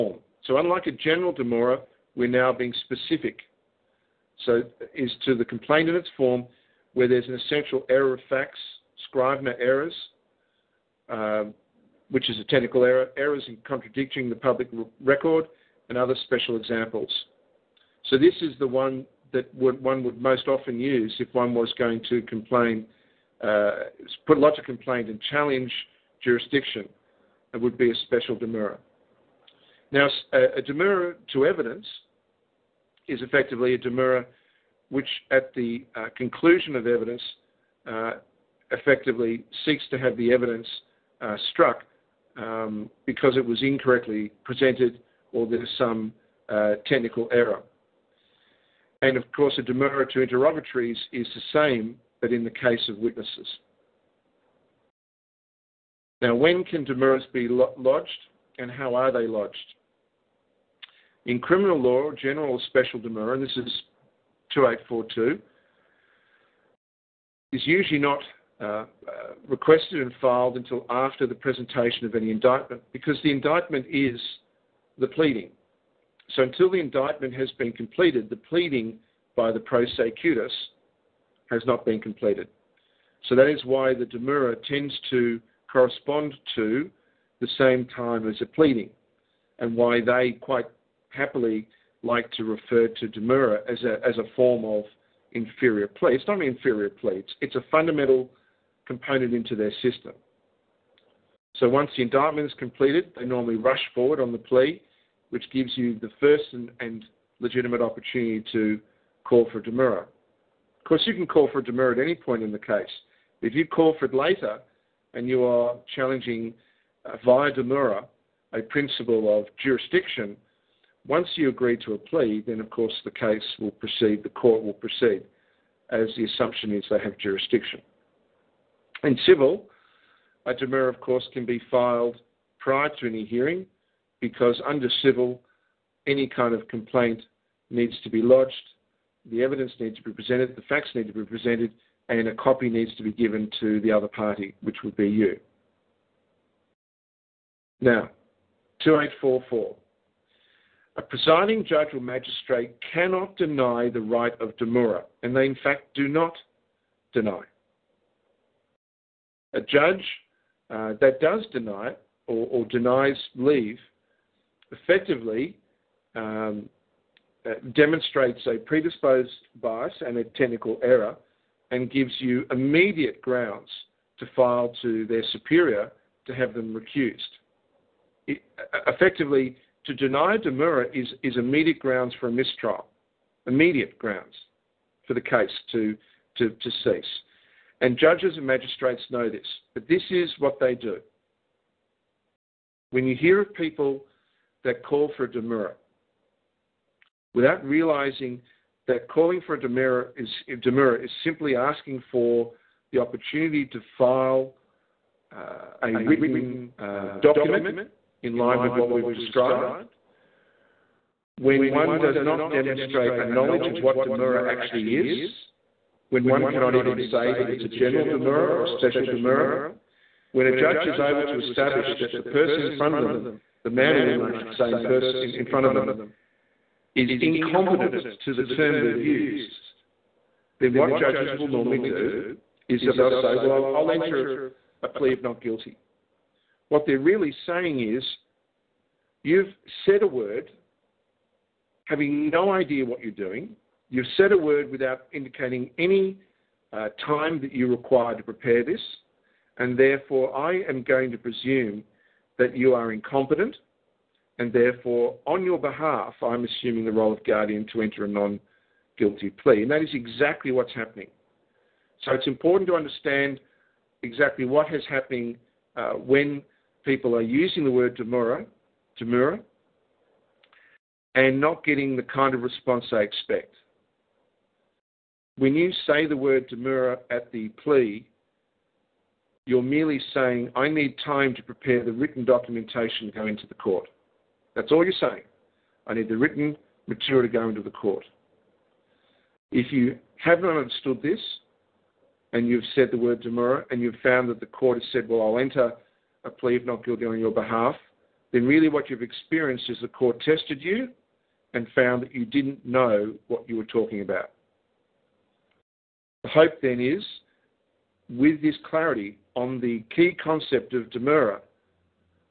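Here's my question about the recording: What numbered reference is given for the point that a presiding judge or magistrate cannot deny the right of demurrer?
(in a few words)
2844.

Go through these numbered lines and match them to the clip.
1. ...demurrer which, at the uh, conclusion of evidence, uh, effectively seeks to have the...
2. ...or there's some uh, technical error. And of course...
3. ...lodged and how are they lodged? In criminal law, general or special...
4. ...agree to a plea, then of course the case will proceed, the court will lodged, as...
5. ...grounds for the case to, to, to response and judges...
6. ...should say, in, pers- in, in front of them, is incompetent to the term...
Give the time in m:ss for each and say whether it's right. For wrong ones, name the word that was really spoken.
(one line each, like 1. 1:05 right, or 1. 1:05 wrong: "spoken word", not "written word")
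1. 0:33 right
2. 0:45 right
3. 0:57 right
4. 2:01 wrong: "proceed", not "lodged"
5. 3:03 wrong: "cease", not "response"
6. 3:44 right.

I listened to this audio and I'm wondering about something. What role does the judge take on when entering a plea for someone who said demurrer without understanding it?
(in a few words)
guardian.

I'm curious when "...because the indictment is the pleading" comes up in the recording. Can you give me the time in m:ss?
1:12.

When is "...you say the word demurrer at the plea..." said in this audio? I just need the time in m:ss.
4:35.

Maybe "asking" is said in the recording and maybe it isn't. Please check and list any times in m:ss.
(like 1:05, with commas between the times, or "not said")
3:21.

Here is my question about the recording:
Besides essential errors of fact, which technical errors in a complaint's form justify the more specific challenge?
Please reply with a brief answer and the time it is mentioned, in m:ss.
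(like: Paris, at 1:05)
scrivener errors, at 0:09.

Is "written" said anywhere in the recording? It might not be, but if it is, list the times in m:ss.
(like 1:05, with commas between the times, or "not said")
3:25, 4:41, 4:46.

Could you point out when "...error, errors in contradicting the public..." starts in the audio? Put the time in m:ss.
0:12.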